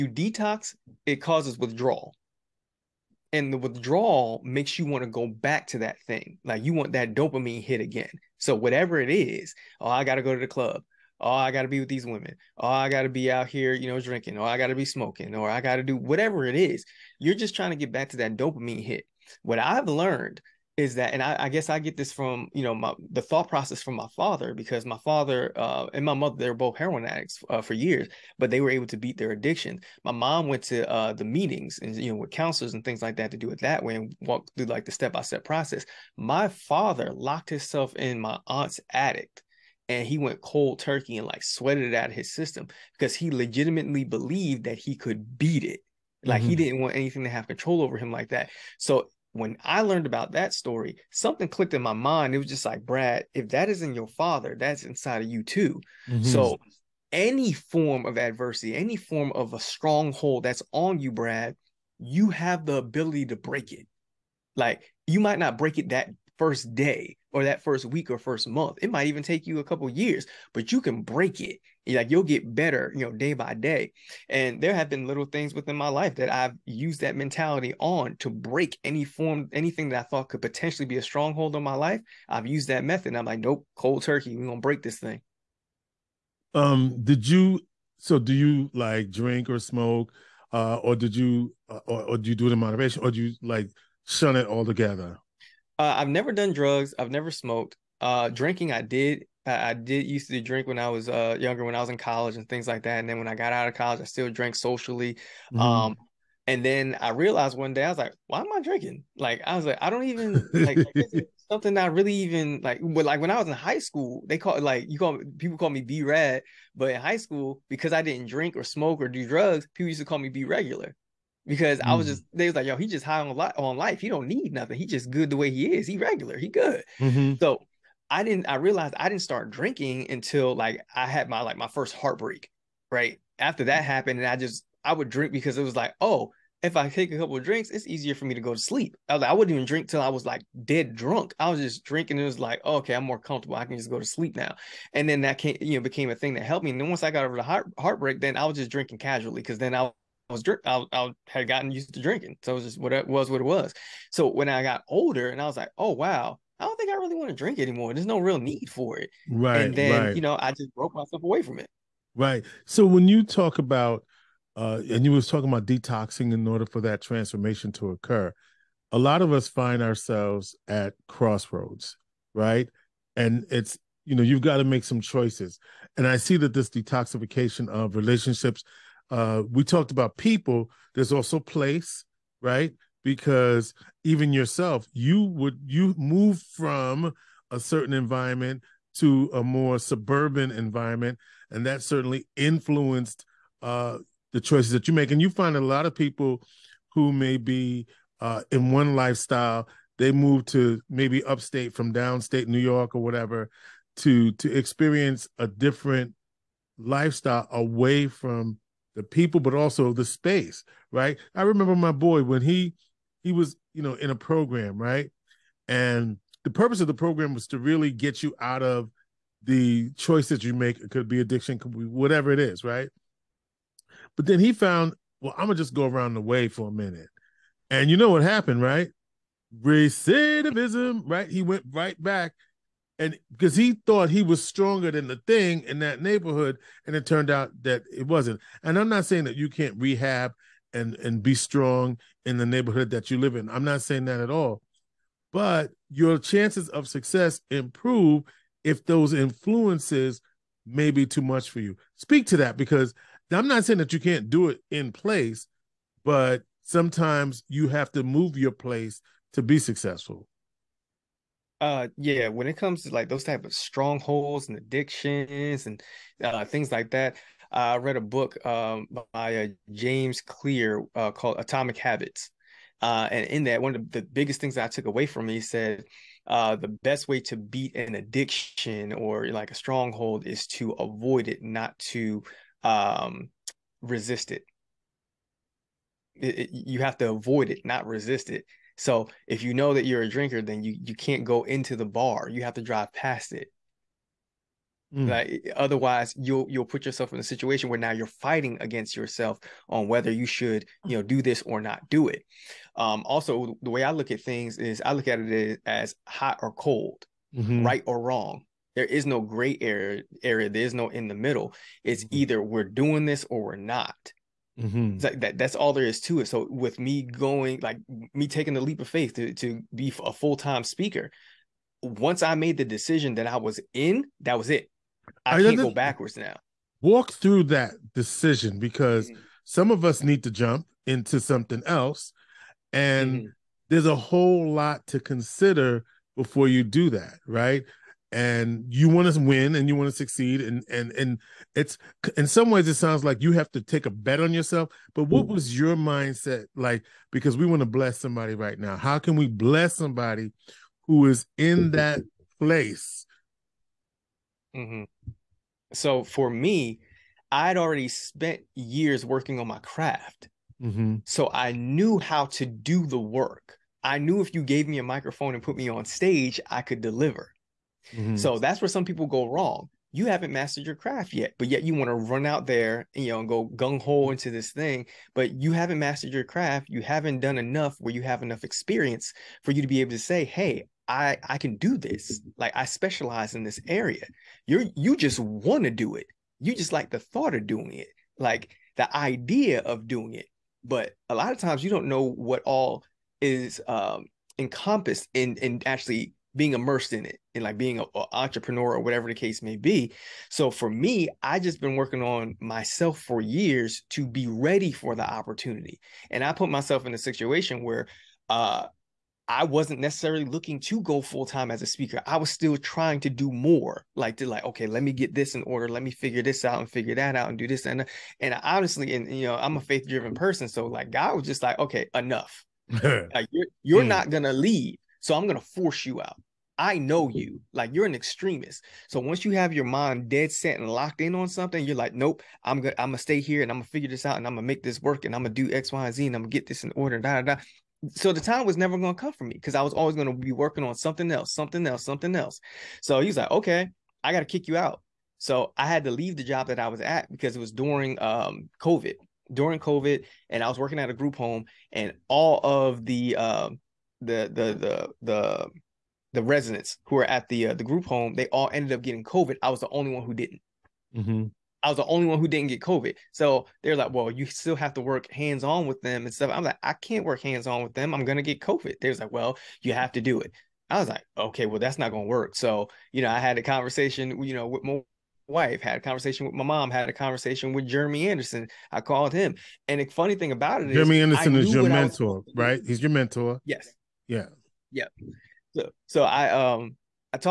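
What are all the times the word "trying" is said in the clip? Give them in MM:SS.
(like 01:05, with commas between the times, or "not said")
00:17, 06:52.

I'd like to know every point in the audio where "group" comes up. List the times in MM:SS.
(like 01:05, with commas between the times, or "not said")
07:30, 07:37.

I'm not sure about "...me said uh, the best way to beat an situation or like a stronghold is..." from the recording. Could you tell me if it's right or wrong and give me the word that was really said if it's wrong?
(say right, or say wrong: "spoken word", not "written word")
wrong: "addiction", not "situation".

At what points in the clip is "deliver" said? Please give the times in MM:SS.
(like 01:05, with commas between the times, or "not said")
06:06.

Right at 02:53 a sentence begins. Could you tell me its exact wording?
And it's you know you've got to make some choices.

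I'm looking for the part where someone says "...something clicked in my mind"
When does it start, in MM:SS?
00:51.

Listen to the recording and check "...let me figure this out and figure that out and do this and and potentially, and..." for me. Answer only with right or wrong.
wrong.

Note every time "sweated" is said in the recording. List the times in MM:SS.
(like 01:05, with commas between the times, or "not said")
00:41.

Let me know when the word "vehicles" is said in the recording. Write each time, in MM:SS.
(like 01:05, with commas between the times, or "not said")
not said.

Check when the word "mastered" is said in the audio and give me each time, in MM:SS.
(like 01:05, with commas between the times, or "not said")
06:10, 06:15.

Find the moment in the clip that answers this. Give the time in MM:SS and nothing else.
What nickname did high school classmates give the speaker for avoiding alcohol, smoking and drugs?
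02:00.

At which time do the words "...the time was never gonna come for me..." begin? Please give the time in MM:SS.
07:18.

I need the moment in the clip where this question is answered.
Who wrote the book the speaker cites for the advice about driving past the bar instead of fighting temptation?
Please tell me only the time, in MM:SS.
04:29.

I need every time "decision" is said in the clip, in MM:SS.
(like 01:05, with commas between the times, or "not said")
05:22, 05:27.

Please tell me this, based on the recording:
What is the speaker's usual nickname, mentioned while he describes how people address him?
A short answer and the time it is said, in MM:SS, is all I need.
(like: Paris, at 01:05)
B Rad, at 01:55.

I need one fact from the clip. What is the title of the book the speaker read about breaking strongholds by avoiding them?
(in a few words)
Atomic Habits.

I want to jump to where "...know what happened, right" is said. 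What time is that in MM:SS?
03:47.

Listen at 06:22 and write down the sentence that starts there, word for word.
Like I specialize in this area.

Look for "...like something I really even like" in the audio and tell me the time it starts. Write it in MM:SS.
01:50.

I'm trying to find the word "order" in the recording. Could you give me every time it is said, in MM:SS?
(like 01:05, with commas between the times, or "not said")
02:46, 06:55, 07:16.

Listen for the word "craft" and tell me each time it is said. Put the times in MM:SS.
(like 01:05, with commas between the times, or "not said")
05:59, 06:10, 06:16.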